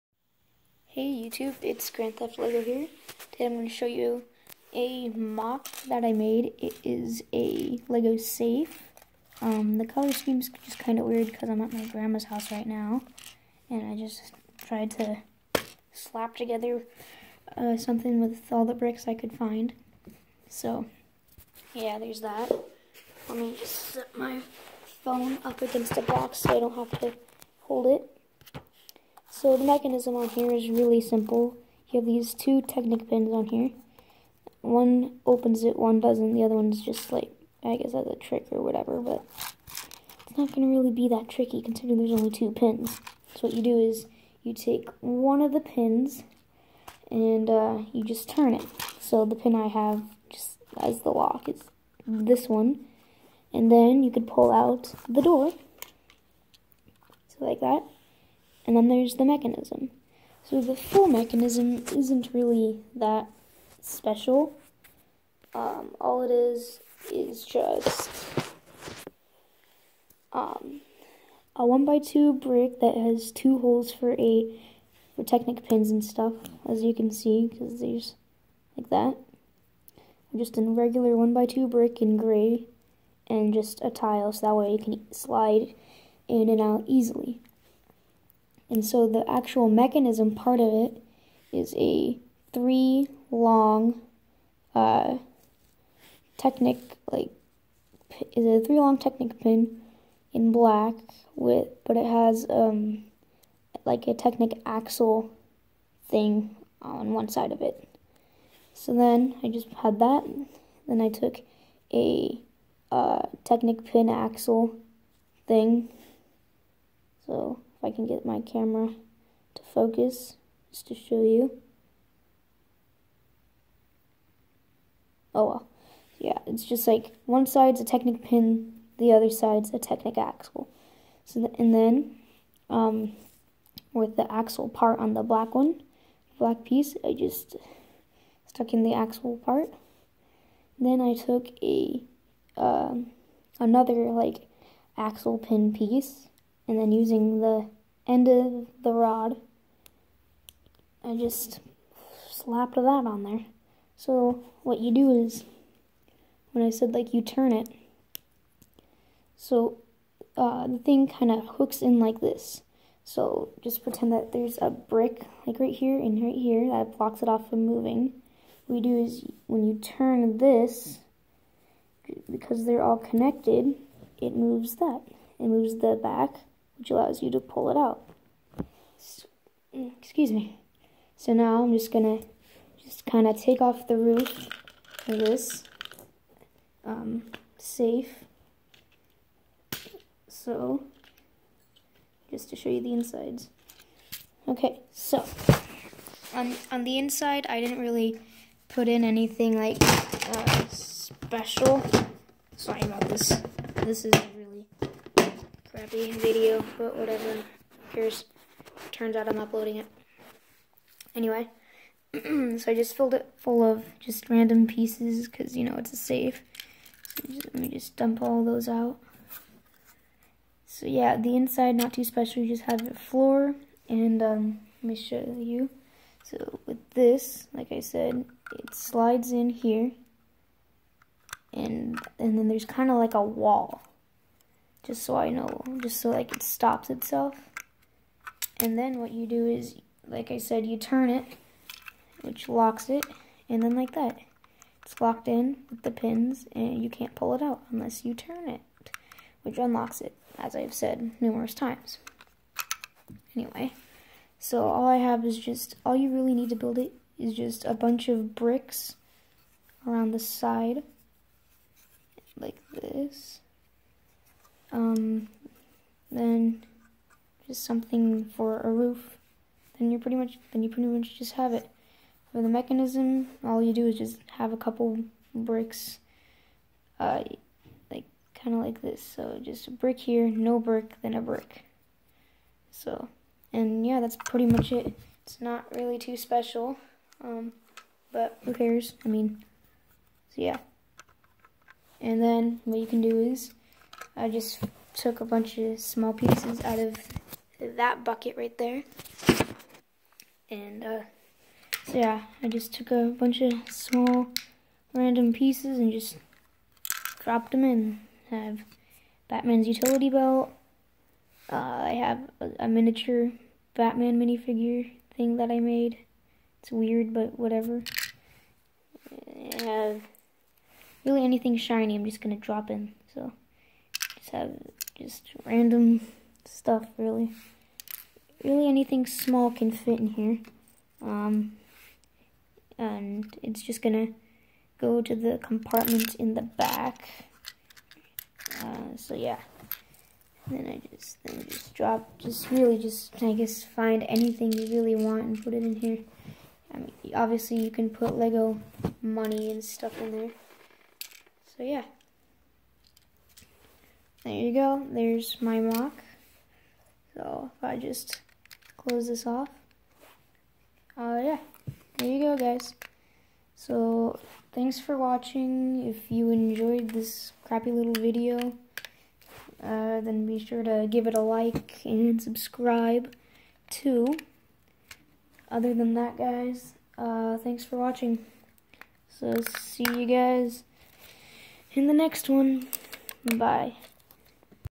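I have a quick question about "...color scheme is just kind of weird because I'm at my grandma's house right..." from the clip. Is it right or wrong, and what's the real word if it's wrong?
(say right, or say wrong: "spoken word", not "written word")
right.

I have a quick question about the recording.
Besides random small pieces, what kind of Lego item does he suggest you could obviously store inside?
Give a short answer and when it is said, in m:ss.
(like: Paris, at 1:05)
Lego money, at 5:48.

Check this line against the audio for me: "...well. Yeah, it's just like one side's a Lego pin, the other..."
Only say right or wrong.
wrong.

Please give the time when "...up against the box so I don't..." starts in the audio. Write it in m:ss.
0:25.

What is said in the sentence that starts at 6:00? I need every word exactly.
Uh, yeah, there you go, guys.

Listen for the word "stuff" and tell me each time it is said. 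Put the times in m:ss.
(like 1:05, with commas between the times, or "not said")
1:16, 5:26, 5:49.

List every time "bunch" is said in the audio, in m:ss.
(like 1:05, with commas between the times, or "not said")
4:17, 4:55, 5:03.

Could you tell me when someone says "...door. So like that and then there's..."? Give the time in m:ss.
0:55.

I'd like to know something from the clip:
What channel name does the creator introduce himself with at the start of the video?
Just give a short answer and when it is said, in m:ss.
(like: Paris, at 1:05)
Grand Theft Lego, at 0:01.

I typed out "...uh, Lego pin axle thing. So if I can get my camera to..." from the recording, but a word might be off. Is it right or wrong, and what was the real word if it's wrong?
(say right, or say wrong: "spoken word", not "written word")
wrong: "Technic", not "Lego".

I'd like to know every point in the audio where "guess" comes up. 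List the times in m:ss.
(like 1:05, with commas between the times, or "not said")
0:37, 5:43.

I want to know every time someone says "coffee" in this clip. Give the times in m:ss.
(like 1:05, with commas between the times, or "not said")
not said.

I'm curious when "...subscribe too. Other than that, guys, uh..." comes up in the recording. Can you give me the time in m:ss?
6:12.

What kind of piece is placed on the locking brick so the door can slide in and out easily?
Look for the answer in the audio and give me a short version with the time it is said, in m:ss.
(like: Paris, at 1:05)
A tile, at 1:23.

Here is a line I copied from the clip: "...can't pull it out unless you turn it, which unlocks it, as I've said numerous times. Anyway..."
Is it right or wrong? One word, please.
right.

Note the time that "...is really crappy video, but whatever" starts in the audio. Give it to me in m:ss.
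3:24.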